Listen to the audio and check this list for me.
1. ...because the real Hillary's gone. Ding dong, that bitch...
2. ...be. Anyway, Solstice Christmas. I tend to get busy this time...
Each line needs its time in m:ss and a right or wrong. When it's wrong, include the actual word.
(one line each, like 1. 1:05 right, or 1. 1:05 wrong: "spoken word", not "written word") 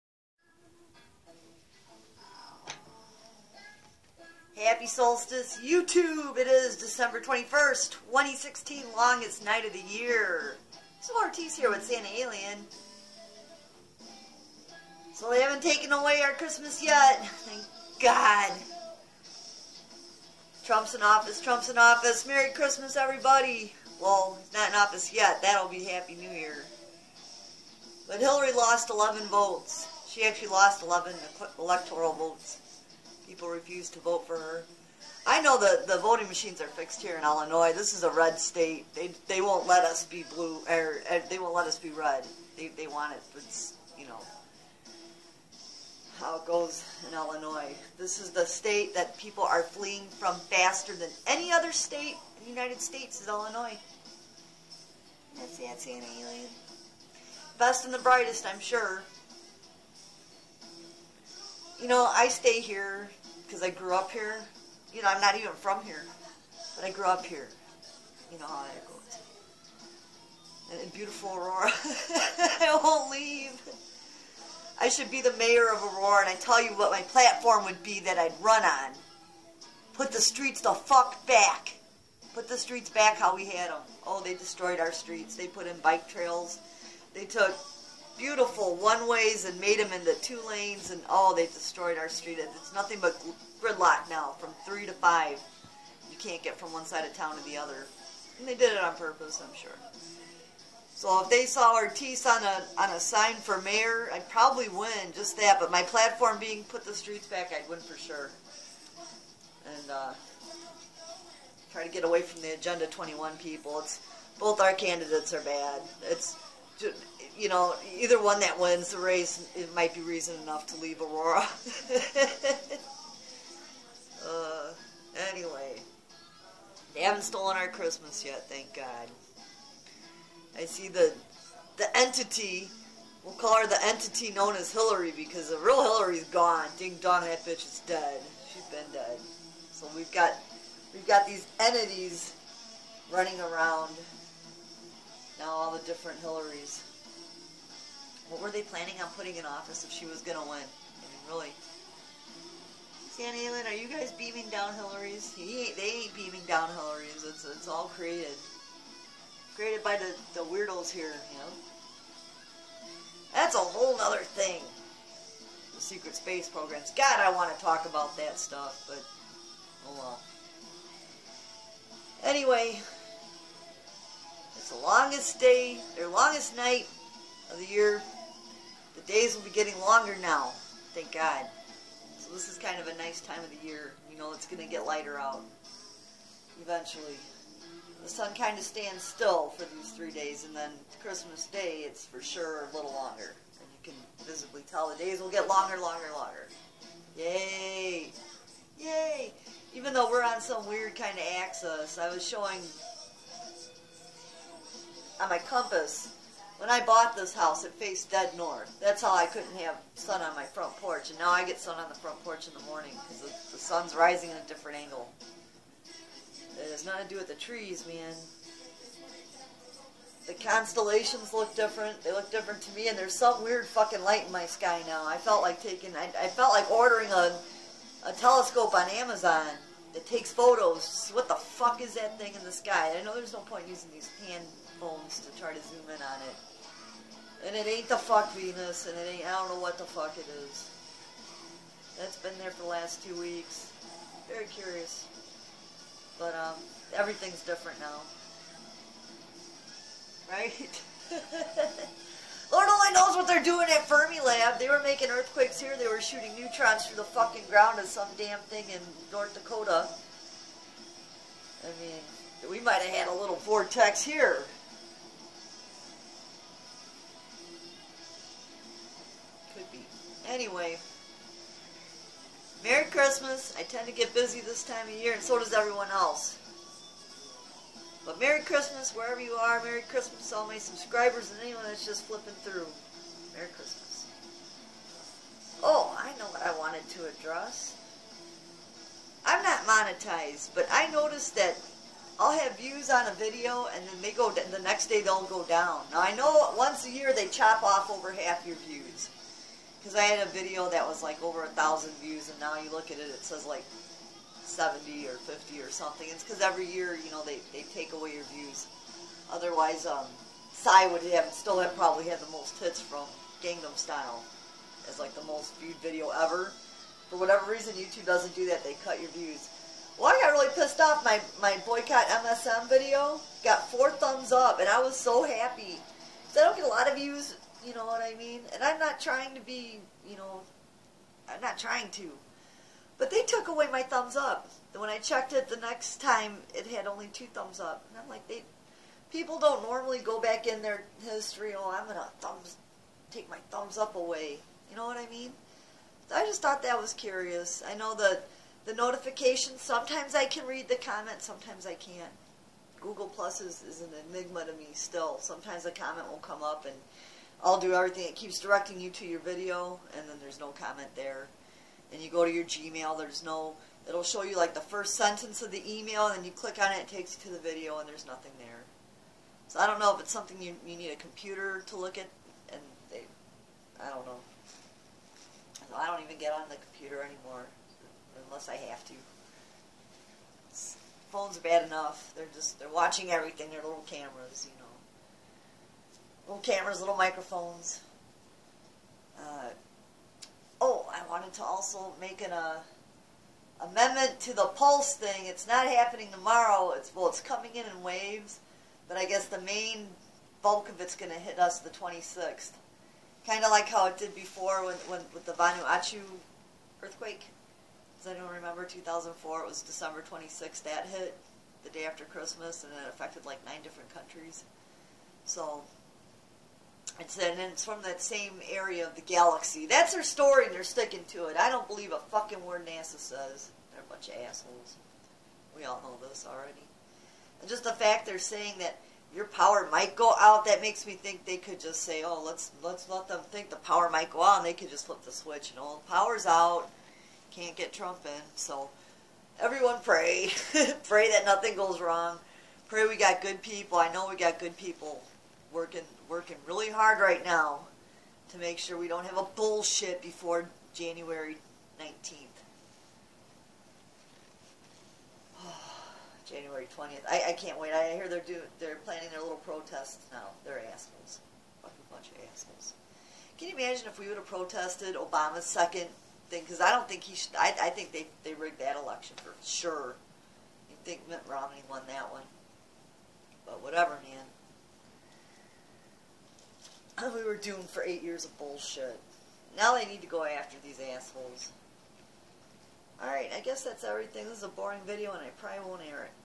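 1. 2:15 right
2. 4:29 wrong: "Merry", not "Solstice".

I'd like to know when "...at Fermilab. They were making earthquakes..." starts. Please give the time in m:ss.
4:13.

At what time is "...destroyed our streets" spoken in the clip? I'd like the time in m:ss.
1:24.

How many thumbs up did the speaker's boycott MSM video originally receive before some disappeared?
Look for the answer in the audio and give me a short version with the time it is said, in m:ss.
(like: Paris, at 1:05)
4, at 5:23.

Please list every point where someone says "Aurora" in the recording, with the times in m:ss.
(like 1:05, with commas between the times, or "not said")
1:11, 1:15, 2:01.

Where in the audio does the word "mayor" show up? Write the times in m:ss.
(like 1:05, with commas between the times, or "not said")
1:15, 1:43.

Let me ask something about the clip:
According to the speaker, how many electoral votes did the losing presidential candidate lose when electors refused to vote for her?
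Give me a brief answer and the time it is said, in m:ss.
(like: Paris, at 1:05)
11, at 0:30.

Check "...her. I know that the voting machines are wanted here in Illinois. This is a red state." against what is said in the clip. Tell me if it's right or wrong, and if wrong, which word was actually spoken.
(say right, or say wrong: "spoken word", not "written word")
wrong: "fixed", not "wanted".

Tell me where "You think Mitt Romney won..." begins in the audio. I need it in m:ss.
7:50.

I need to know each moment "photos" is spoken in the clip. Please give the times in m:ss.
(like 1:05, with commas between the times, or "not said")
3:50.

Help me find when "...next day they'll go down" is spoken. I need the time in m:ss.
4:54.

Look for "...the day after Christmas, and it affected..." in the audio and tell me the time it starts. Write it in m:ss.
6:51.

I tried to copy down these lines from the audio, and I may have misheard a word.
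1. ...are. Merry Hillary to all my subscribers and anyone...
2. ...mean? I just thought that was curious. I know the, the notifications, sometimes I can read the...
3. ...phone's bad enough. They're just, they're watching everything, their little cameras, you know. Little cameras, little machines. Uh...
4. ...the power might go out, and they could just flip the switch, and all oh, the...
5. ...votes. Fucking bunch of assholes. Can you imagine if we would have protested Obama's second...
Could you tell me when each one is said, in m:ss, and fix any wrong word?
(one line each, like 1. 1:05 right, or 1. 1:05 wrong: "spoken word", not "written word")
1. 4:39 wrong: "Christmas", not "Hillary"
2. 5:45 right
3. 6:21 wrong: "microphones", not "machines"
4. 7:13 right
5. 7:40 wrong: "assholes", not "votes".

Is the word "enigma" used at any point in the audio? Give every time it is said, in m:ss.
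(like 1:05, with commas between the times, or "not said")
5:54.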